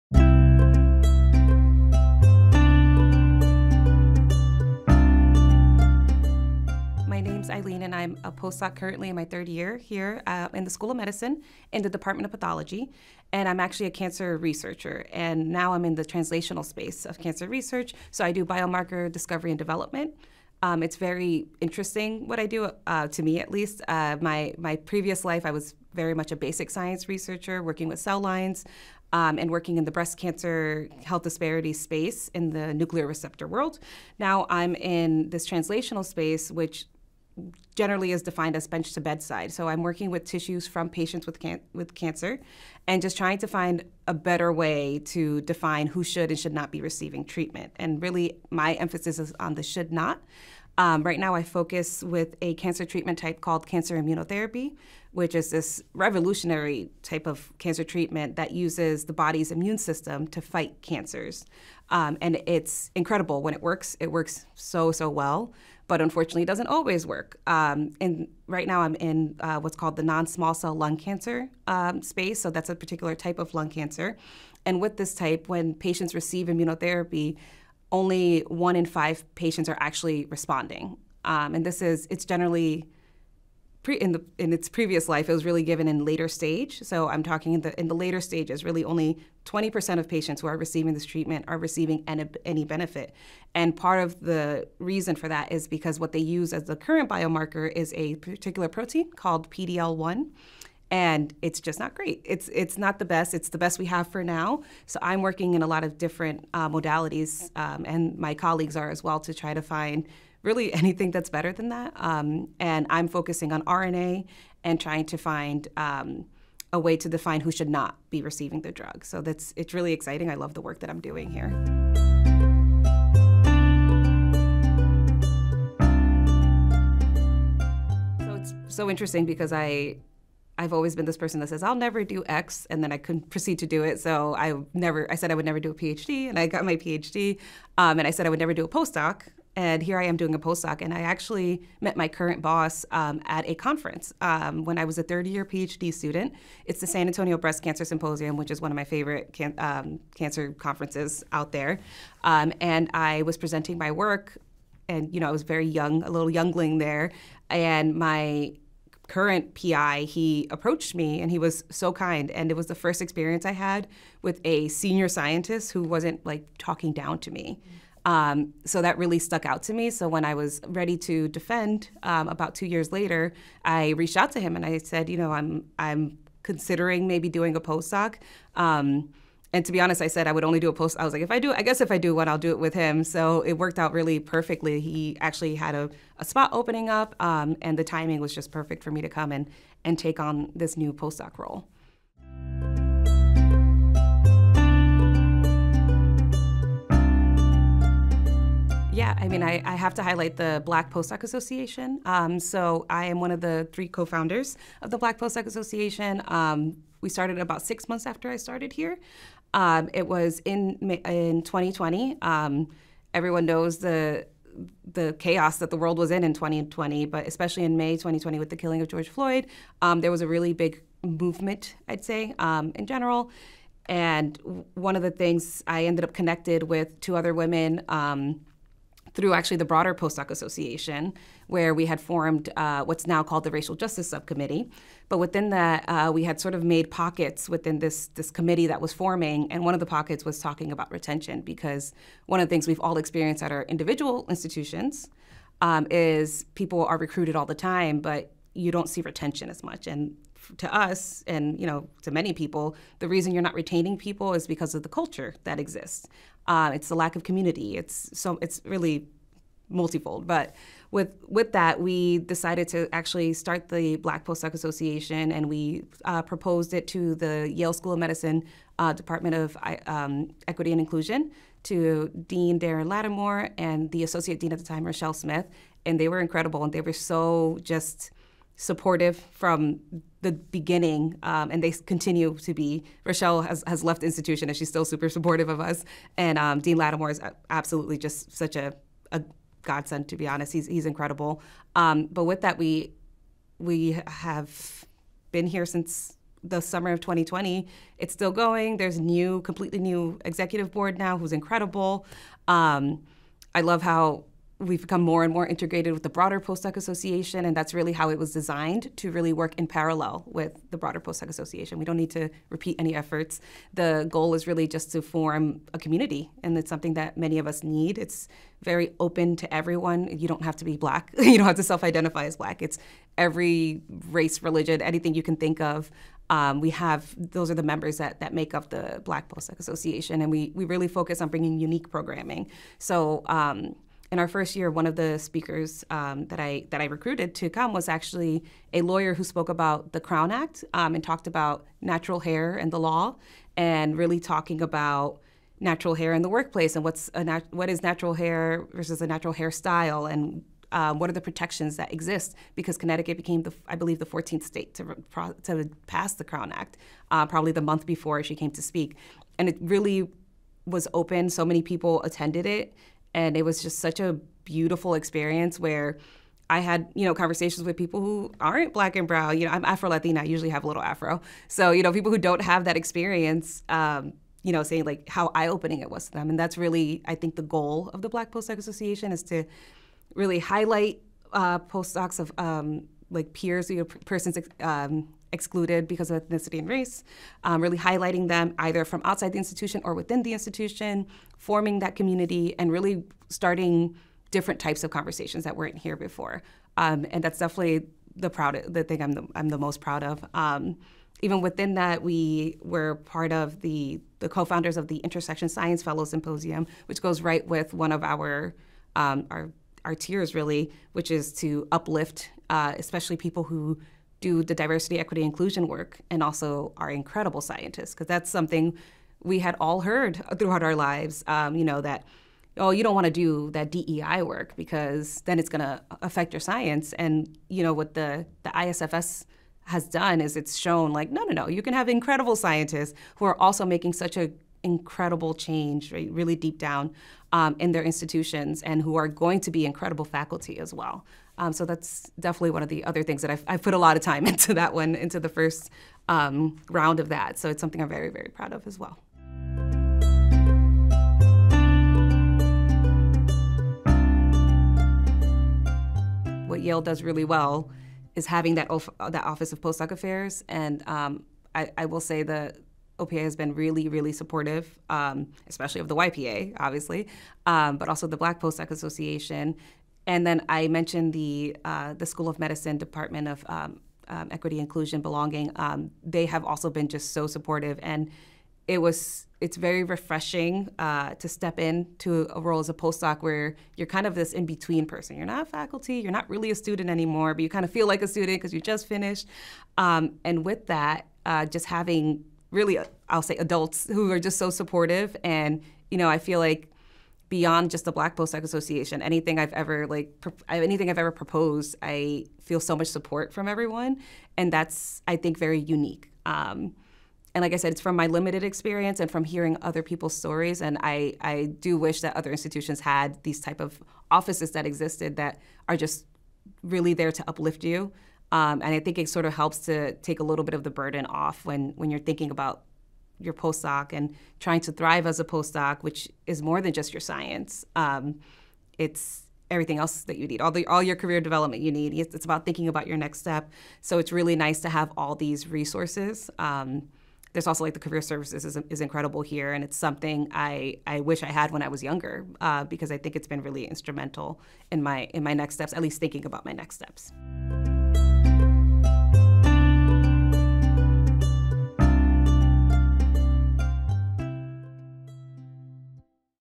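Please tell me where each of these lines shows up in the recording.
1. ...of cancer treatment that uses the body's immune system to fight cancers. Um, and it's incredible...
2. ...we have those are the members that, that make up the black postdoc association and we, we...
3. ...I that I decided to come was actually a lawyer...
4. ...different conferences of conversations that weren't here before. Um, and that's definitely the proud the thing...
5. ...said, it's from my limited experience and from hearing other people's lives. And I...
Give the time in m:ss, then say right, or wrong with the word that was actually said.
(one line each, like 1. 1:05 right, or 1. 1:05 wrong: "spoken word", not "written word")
1. 0:57 right
2. 5:26 right
3. 5:36 wrong: "recruited", not "decided"
4. 6:34 wrong: "types", not "conferences"
5. 8:27 wrong: "stories", not "lives".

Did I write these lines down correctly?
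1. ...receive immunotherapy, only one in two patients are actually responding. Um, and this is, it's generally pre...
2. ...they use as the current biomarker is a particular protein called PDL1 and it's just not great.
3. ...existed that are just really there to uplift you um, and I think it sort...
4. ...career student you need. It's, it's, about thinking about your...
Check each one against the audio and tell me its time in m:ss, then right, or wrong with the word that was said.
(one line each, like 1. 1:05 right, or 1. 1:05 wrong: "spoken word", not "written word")
1. 1:16 wrong: "five", not "two"
2. 1:36 right
3. 8:34 right
4. 8:50 wrong: "development", not "student".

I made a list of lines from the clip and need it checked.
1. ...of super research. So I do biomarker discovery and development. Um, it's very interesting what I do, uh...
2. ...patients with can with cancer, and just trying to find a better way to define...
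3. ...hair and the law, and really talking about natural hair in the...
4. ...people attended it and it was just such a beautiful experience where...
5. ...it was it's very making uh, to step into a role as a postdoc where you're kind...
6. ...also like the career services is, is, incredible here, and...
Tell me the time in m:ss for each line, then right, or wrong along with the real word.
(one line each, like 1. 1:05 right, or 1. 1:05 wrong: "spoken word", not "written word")
1. 0:17 wrong: "cancer", not "super"
2. 0:40 right
3. 5:42 right
4. 6:01 right
5. 7:58 wrong: "refreshing", not "making"
6. 8:57 right.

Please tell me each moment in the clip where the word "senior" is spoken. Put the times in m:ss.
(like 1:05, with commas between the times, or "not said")
2:44.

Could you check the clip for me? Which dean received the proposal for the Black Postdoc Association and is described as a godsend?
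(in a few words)
Darin Latimore.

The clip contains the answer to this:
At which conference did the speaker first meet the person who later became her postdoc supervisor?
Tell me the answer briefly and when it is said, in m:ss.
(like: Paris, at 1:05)
San Antonio Breast Cancer Symposium, at 2:26.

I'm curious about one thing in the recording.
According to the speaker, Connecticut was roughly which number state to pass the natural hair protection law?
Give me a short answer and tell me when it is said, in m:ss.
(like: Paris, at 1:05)
14th, at 5:54.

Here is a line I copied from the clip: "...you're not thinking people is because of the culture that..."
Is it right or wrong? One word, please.
wrong.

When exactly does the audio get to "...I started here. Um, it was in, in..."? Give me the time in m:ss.
3:28.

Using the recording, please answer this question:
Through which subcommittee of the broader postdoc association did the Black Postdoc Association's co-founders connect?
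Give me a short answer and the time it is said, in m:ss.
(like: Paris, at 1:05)
Racial Justice Subcommittee, at 3:53.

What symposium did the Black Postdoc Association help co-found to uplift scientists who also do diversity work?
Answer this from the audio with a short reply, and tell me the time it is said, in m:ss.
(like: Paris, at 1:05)
Intersection Science Fellow Symposium, at 6:44.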